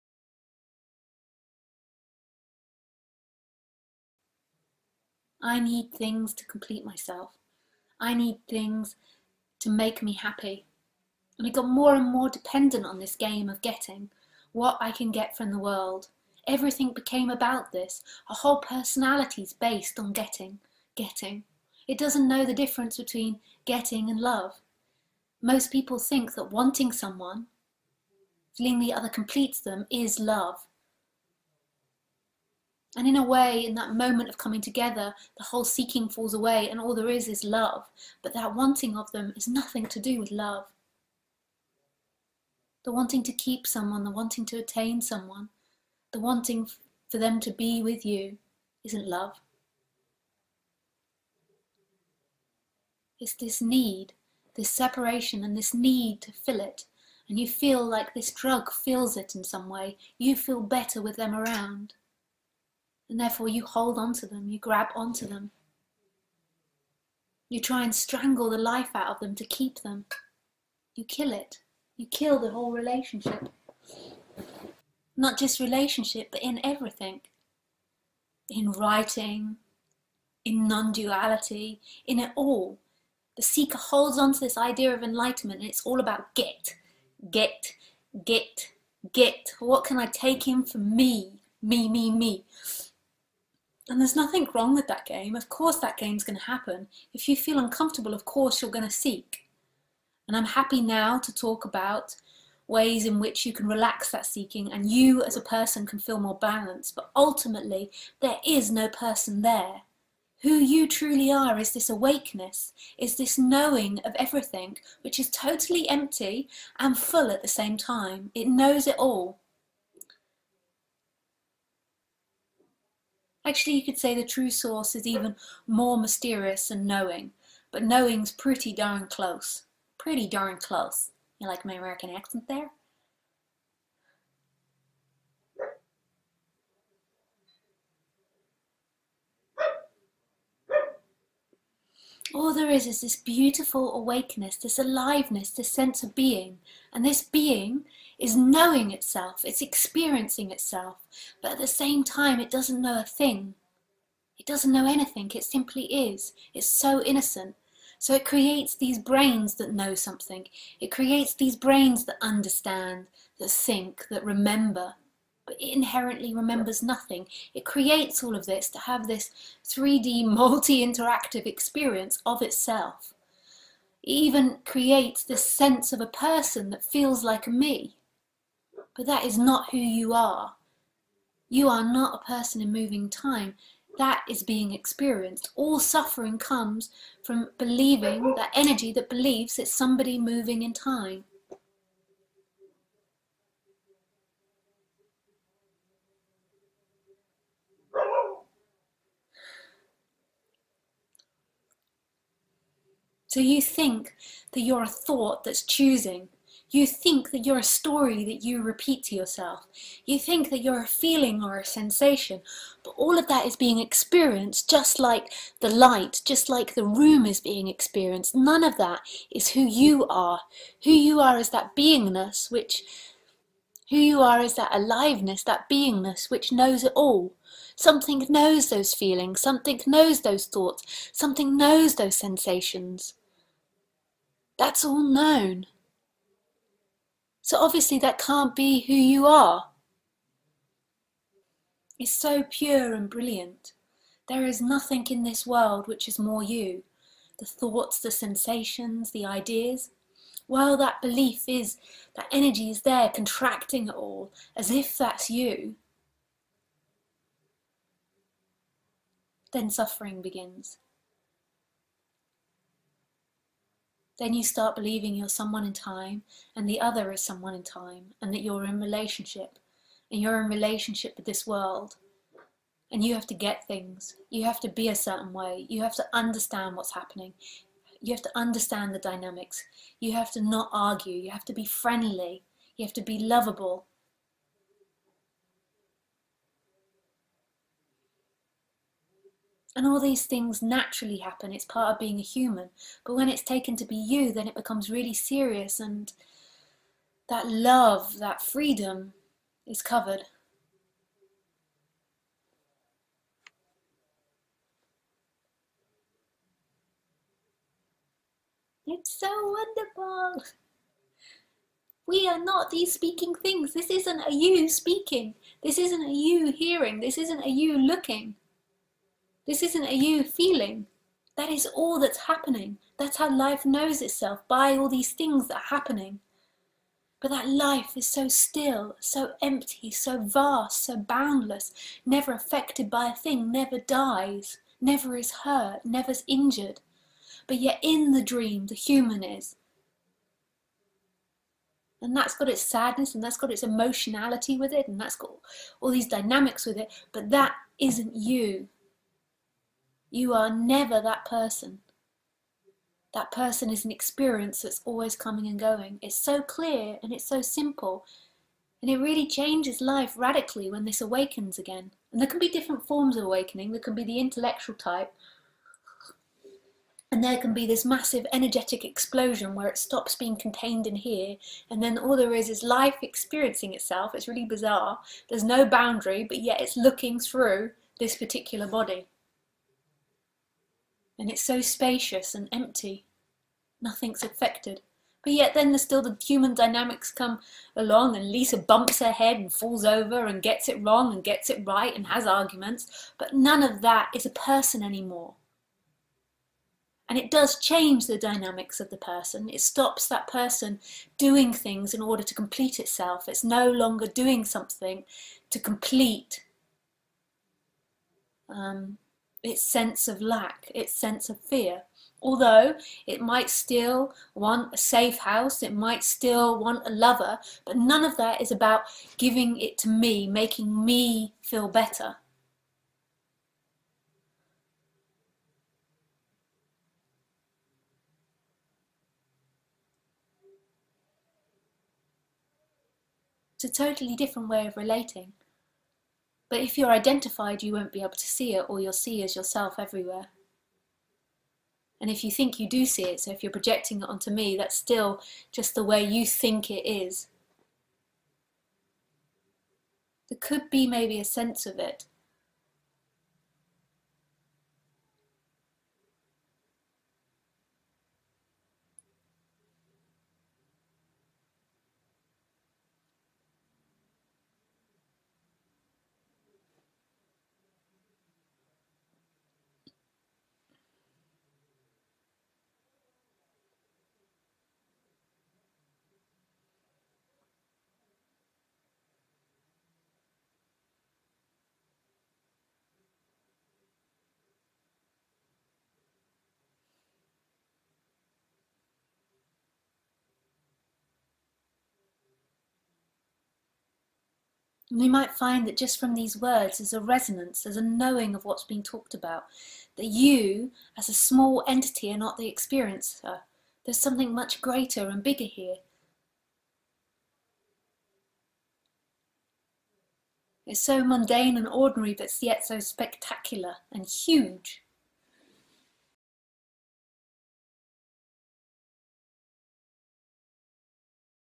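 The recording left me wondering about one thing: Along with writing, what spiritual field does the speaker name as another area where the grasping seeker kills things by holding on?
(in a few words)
Non duality.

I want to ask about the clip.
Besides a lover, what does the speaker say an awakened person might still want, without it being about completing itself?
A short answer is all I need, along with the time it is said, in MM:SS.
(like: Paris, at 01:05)
A safe house, at 06:54.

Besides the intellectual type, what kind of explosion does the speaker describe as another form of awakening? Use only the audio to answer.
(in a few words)
Massive energetic explosion.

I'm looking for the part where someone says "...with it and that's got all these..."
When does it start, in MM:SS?
05:44.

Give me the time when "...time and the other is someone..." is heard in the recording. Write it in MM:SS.
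04:25.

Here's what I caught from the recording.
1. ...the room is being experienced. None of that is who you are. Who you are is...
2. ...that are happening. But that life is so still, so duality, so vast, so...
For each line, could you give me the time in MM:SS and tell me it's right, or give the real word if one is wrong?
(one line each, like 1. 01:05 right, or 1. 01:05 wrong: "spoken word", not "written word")
1. 03:36 right
2. 05:25 wrong: "empty", not "duality".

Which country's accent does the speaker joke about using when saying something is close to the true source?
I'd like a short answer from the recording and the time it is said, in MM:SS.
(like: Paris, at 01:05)
American, at 02:11.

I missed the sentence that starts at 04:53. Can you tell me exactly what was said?
But when it's taken to be you, then it becomes really serious, and that love, that freedom is covered.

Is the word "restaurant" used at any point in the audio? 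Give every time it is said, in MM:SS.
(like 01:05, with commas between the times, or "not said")
not said.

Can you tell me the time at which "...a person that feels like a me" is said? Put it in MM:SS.
02:56.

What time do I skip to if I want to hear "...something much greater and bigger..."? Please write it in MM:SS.
08:23.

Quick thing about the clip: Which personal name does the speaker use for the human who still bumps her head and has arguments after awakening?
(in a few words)
Lisa.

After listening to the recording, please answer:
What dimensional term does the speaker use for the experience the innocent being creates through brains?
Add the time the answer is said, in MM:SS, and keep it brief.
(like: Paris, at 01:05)
3D, at 02:49.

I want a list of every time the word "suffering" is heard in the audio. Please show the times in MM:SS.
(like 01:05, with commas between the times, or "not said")
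03:05, 04:19.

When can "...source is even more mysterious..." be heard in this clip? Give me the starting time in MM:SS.
02:04.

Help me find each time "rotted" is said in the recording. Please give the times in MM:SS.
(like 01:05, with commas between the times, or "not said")
not said.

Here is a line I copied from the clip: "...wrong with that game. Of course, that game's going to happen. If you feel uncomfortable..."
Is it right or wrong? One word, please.
right.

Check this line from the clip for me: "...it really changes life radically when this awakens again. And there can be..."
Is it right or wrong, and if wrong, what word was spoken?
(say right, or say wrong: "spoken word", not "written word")
right.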